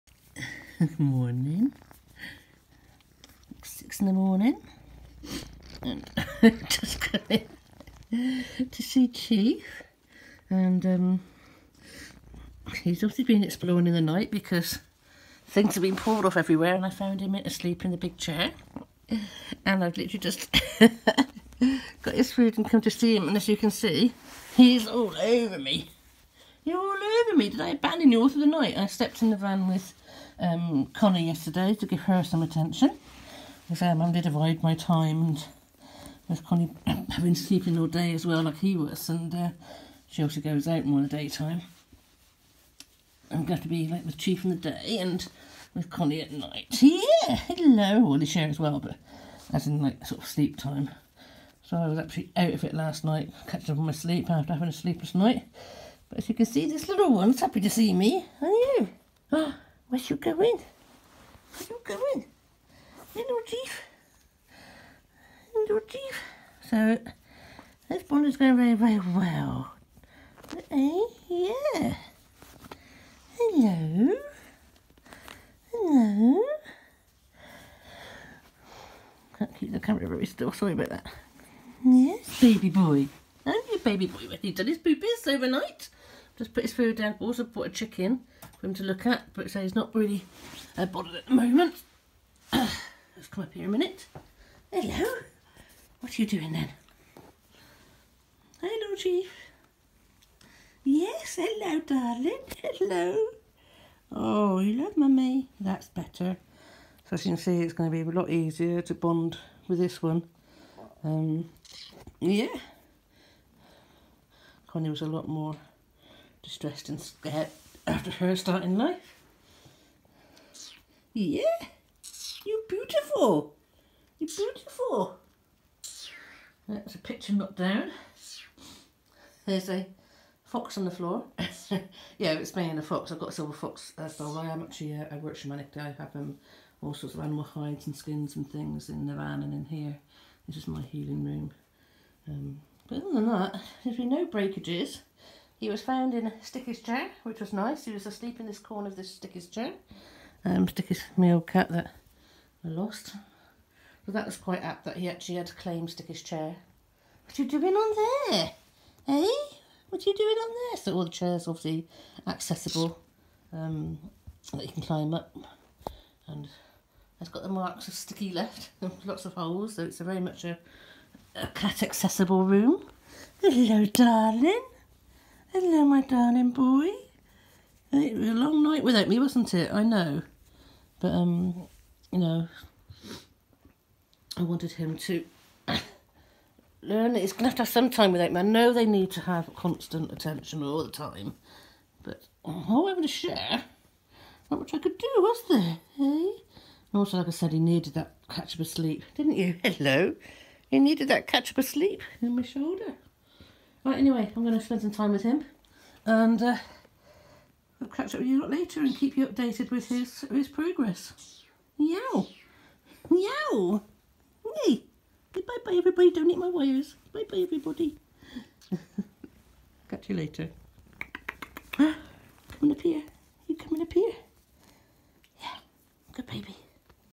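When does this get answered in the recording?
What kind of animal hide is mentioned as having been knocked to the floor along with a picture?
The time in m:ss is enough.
2:13.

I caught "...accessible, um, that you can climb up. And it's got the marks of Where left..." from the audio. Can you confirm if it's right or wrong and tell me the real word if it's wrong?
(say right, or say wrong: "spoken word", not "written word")
wrong: "Sticky", not "Where".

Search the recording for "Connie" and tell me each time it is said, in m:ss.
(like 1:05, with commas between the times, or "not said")
0:30, 0:36, 0:45, 1:54.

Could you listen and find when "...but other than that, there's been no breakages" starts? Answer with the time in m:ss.
2:22.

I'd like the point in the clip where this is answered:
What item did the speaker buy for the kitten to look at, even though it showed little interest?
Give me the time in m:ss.
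1:27.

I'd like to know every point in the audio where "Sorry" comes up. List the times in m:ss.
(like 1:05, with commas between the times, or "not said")
1:20.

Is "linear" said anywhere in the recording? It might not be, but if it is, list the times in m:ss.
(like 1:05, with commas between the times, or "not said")
not said.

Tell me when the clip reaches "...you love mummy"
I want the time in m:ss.
1:44.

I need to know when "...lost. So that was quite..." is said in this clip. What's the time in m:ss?
2:32.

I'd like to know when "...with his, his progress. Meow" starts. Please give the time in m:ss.
3:29.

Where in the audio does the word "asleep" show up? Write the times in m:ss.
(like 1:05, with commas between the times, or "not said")
0:17, 2:28.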